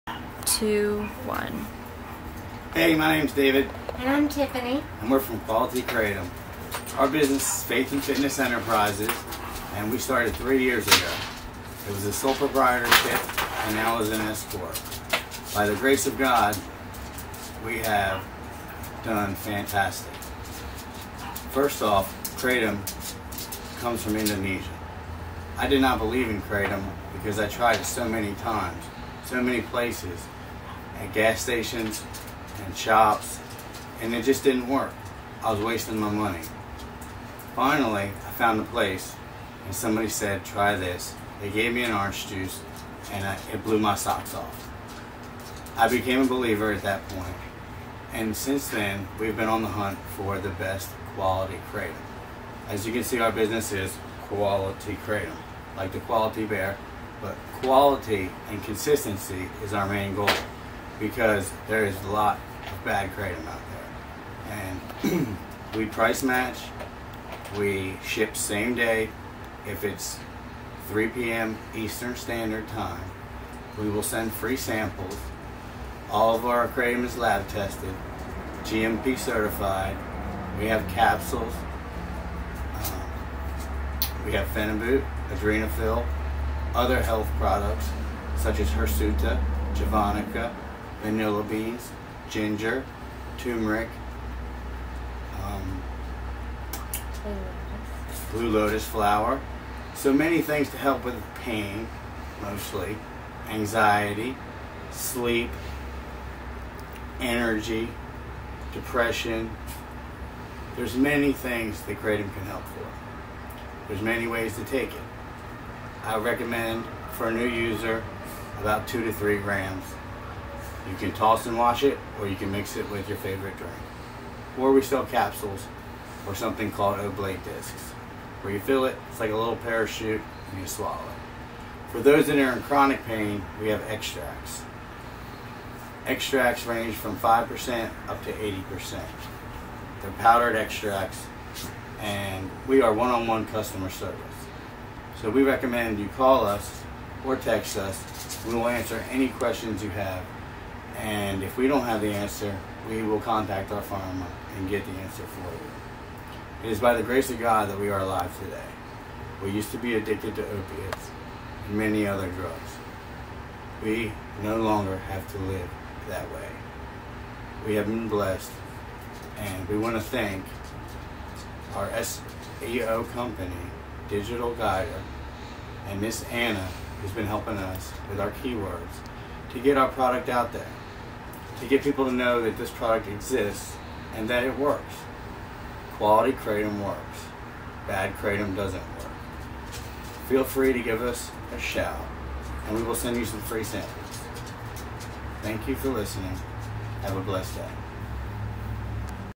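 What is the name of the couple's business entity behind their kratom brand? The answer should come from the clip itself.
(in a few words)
Faith and Fitness Enterprises.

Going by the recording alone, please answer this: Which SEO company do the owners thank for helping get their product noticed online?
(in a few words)
Digital Guider.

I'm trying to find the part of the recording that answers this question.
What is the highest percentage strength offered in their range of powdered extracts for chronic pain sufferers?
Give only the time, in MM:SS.
02:18.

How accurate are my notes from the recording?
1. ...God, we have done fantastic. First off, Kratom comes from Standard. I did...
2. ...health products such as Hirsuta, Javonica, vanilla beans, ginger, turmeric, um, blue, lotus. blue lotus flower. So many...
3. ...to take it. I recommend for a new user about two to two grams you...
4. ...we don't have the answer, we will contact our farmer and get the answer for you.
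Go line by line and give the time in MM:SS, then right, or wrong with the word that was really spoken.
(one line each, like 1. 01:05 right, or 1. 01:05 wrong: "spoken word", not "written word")
1. 00:16 wrong: "Indonesia", not "Standard"
2. 01:27 right
3. 01:54 wrong: "three", not "two"
4. 02:31 right.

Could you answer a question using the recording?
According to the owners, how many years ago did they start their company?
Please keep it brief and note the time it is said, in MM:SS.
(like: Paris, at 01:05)
3, at 00:10.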